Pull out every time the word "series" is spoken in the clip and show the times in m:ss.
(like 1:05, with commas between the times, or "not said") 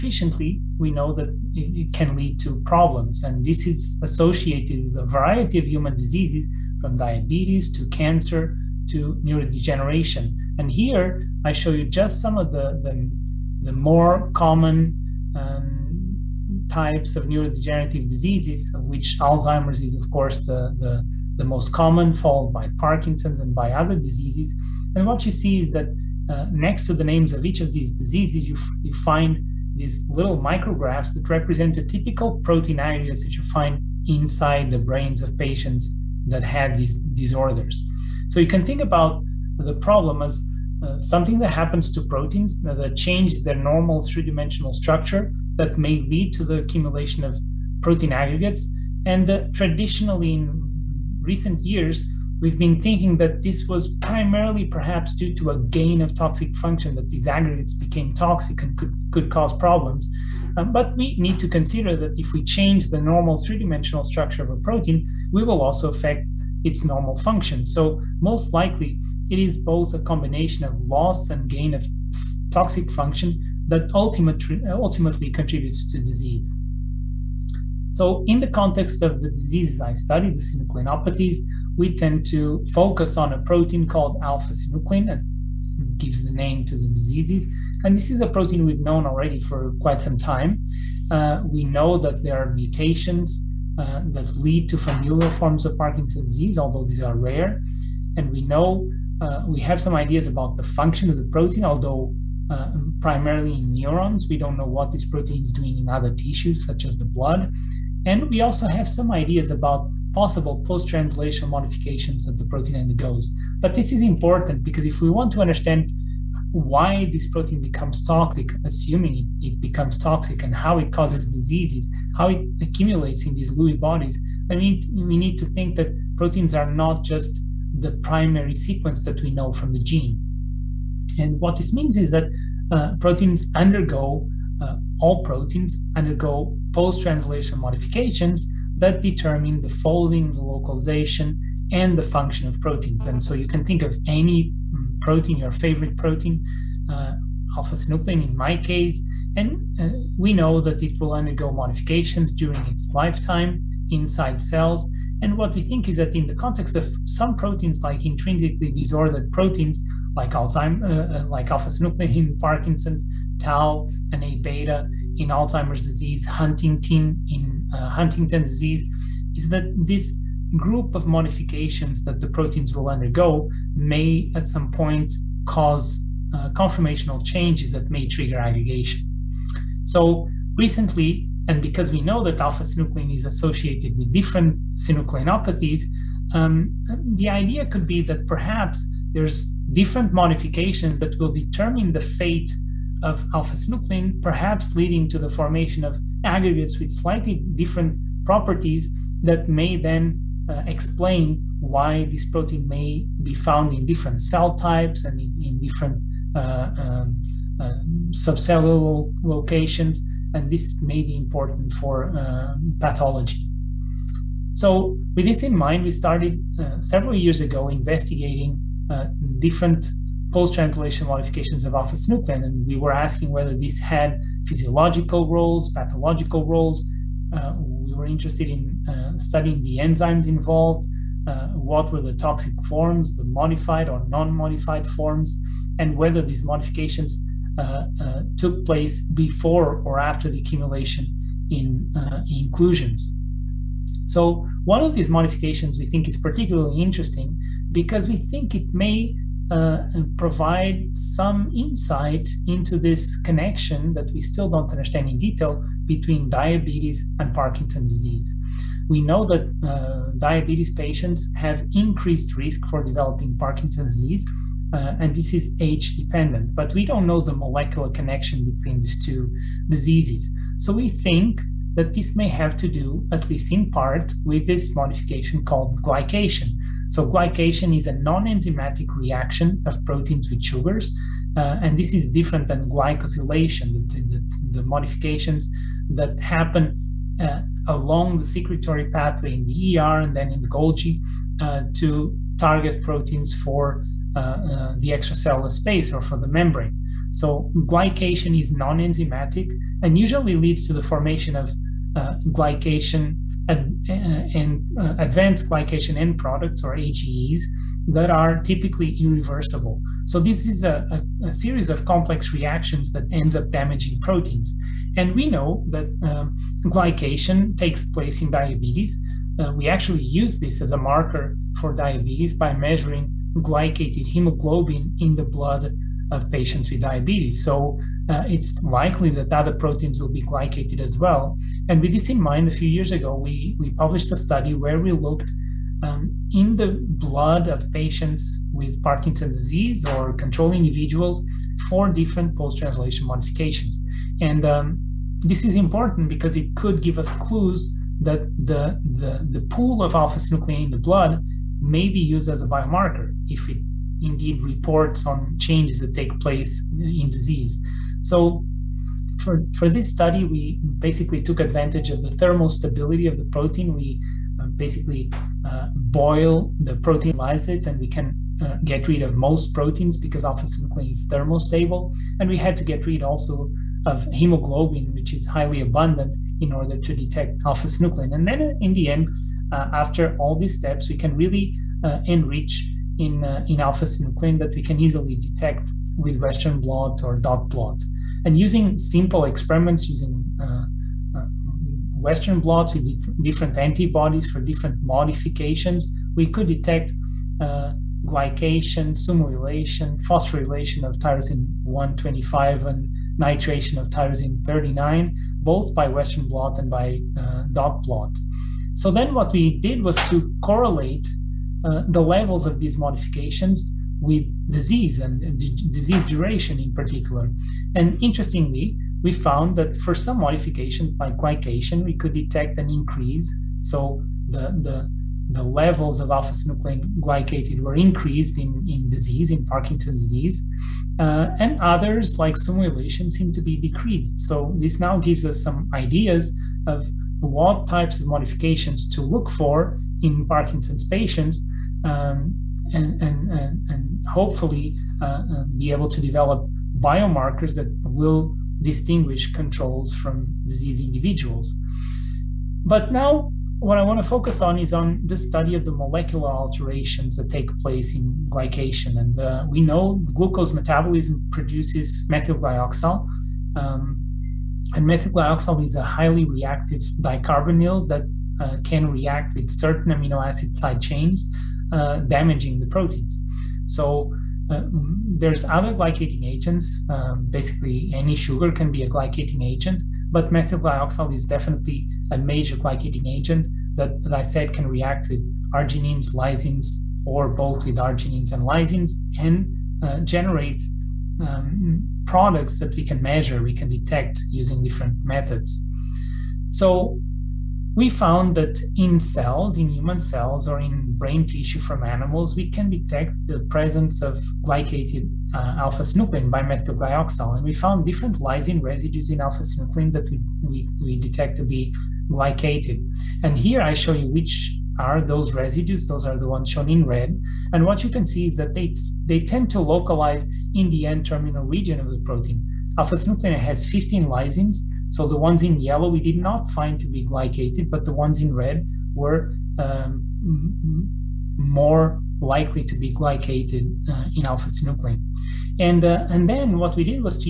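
5:11.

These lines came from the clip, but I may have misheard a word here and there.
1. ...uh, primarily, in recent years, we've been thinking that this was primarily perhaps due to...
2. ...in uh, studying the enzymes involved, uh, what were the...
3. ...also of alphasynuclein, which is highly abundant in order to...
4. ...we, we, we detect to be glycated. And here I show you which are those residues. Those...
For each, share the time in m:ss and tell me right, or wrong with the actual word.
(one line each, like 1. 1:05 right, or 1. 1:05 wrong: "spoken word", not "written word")
1. 0:49 wrong: "traditionally", not "primarily"
2. 3:48 right
3. 6:13 wrong: "hemoglobin", not "alphasynuclein"
4. 8:30 right.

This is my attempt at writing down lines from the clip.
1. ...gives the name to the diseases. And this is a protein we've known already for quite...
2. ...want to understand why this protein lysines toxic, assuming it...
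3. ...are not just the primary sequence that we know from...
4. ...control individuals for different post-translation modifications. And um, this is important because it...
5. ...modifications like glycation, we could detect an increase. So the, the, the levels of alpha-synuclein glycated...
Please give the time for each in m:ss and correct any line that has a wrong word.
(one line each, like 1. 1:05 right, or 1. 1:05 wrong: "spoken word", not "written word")
1. 1:25 right
2. 1:55 wrong: "becomes", not "lysines"
3. 2:06 right
4. 5:40 right
5. 7:00 right.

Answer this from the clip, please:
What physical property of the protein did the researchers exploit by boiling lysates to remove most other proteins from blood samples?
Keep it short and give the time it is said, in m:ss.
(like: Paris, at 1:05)
thermal stability, at 6:02.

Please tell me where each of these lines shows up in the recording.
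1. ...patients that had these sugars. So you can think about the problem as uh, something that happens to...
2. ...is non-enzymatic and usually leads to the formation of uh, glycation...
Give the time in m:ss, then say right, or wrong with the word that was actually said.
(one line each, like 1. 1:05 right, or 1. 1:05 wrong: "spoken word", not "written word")
1. 0:35 wrong: "disorders", not "sugars"
2. 4:58 right.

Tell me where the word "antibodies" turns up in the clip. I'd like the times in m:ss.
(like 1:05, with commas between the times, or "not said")
6:33.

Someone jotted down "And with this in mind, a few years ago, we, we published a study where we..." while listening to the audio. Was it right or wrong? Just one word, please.
right.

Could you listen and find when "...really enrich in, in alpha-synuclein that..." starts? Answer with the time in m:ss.
6:21.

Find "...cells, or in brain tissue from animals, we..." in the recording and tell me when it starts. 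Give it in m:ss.
8:19.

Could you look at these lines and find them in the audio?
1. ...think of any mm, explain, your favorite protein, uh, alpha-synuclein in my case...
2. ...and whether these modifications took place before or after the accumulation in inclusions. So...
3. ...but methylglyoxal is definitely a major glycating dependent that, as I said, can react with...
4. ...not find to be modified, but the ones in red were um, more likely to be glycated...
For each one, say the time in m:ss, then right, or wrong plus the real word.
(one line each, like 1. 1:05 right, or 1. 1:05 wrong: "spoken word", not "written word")
1. 2:23 wrong: "protein", not "explain"
2. 3:55 right
3. 8:00 wrong: "agent", not "dependent"
4. 8:46 wrong: "glycated", not "modified".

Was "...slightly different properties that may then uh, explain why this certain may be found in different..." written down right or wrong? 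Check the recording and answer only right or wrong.
wrong.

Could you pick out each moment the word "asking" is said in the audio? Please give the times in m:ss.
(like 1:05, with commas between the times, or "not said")
3:42.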